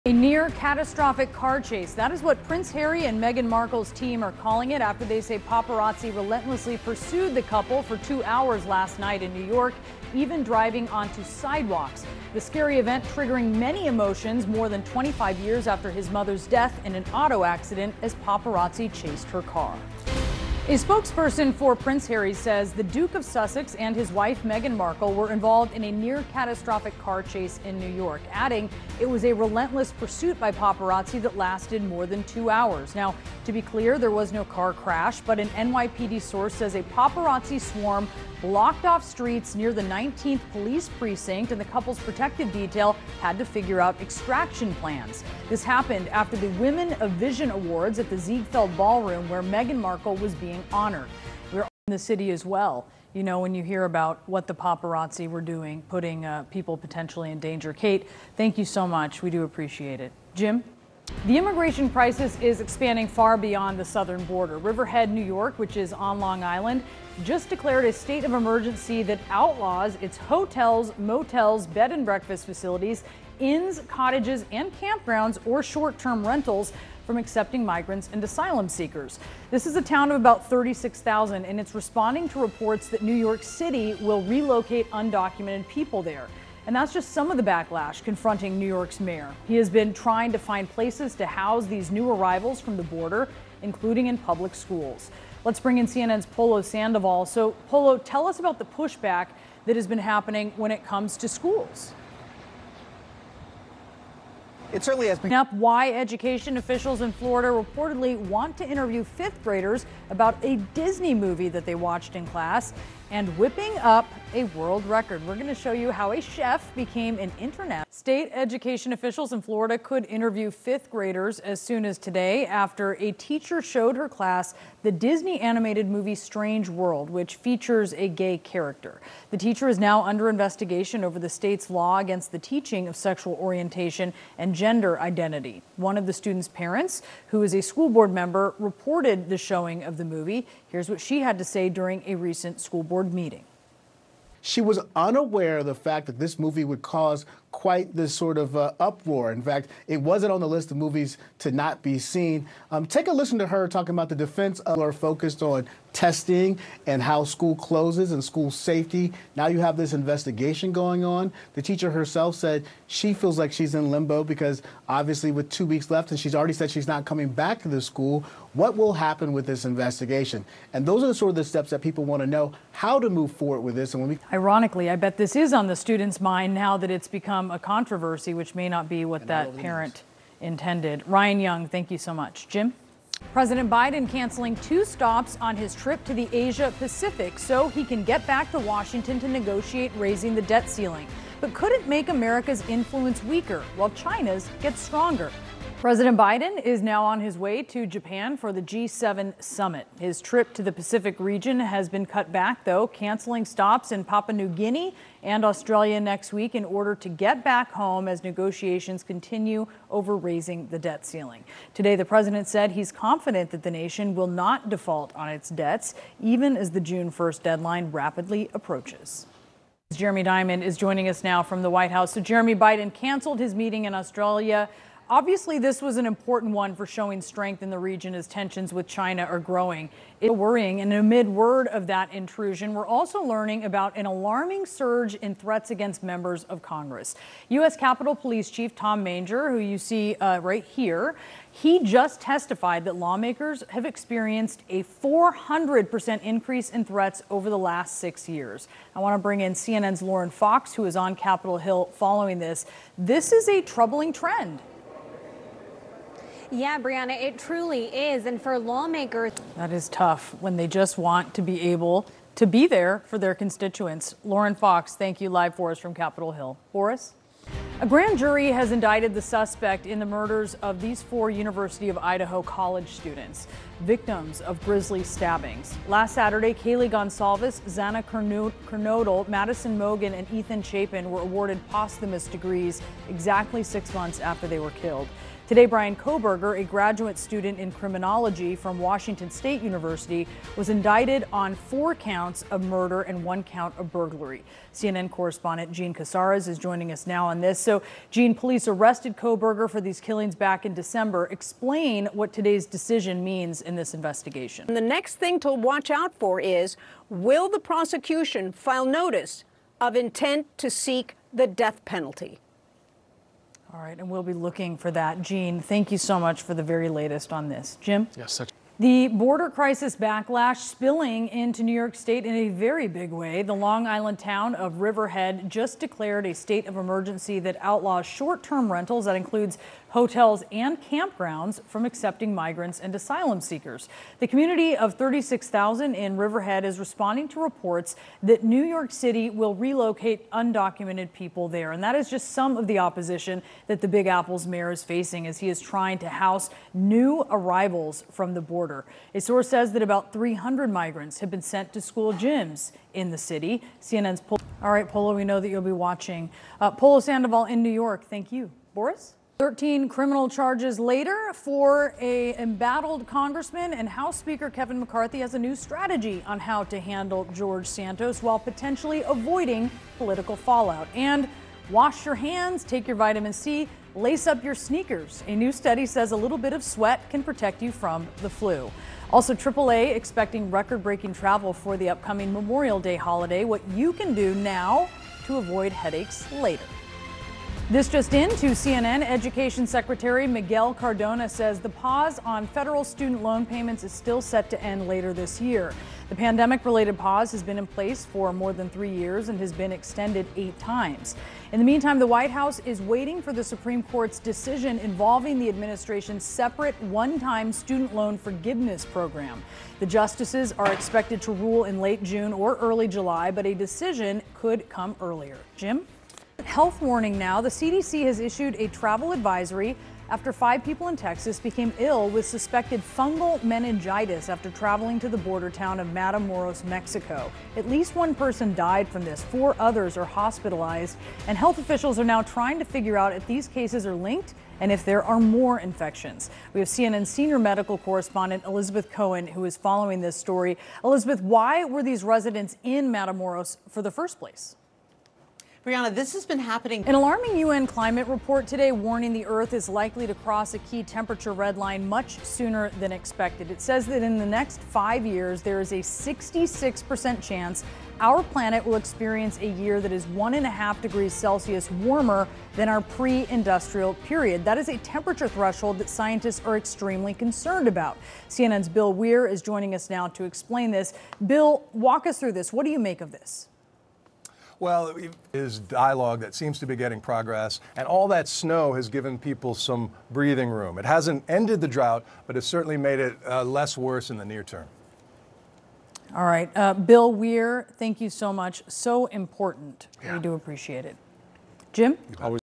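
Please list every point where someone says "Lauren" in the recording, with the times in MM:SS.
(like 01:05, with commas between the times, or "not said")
04:10, 04:24.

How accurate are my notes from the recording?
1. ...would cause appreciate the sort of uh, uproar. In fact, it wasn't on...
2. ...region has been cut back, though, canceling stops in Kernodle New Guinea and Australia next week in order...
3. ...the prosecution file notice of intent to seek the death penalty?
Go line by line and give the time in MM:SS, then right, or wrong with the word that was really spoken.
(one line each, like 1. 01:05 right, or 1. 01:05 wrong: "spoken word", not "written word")
1. 02:26 wrong: "quite", not "appreciate"
2. 03:21 wrong: "Papua", not "Kernodle"
3. 05:07 right.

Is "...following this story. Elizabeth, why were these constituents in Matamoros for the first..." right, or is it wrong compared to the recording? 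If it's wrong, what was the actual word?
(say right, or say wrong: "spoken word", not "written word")
wrong: "residents", not "constituents".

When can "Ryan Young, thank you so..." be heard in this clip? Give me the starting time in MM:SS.
03:01.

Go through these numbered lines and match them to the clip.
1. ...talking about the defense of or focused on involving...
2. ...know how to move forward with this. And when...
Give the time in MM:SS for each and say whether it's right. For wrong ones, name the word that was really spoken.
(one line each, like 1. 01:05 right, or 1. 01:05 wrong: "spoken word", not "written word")
1. 02:33 wrong: "testing", not "involving"
2. 02:52 right.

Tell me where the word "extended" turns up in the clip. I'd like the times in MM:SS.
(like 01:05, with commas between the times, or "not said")
06:39.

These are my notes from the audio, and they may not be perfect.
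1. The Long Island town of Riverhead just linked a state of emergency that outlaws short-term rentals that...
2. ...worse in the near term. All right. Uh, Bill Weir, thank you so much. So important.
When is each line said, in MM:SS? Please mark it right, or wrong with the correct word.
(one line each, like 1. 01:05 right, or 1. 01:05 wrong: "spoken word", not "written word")
1. 05:23 wrong: "declared", not "linked"
2. 08:03 right.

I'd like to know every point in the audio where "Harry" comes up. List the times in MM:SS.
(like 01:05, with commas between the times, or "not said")
00:02, 00:22.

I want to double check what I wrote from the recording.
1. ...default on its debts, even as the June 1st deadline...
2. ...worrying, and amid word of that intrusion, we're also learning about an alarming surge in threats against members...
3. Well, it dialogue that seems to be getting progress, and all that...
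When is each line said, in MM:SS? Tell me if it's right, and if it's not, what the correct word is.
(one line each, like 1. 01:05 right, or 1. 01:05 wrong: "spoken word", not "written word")
1. 03:34 right
2. 03:50 right
3. 07:54 right.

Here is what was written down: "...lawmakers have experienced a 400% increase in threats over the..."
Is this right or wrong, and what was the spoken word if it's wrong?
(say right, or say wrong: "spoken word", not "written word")
right.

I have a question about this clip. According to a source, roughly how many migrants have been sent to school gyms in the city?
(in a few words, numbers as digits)
300.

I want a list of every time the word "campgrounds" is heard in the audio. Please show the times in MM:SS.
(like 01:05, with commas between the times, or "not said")
01:14, 05:30.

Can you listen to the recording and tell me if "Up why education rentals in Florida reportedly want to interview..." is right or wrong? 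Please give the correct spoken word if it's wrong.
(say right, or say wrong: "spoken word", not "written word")
wrong: "officials", not "rentals".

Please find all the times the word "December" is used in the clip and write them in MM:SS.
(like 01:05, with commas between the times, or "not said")
05:00.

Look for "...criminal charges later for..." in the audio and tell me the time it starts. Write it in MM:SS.
05:59.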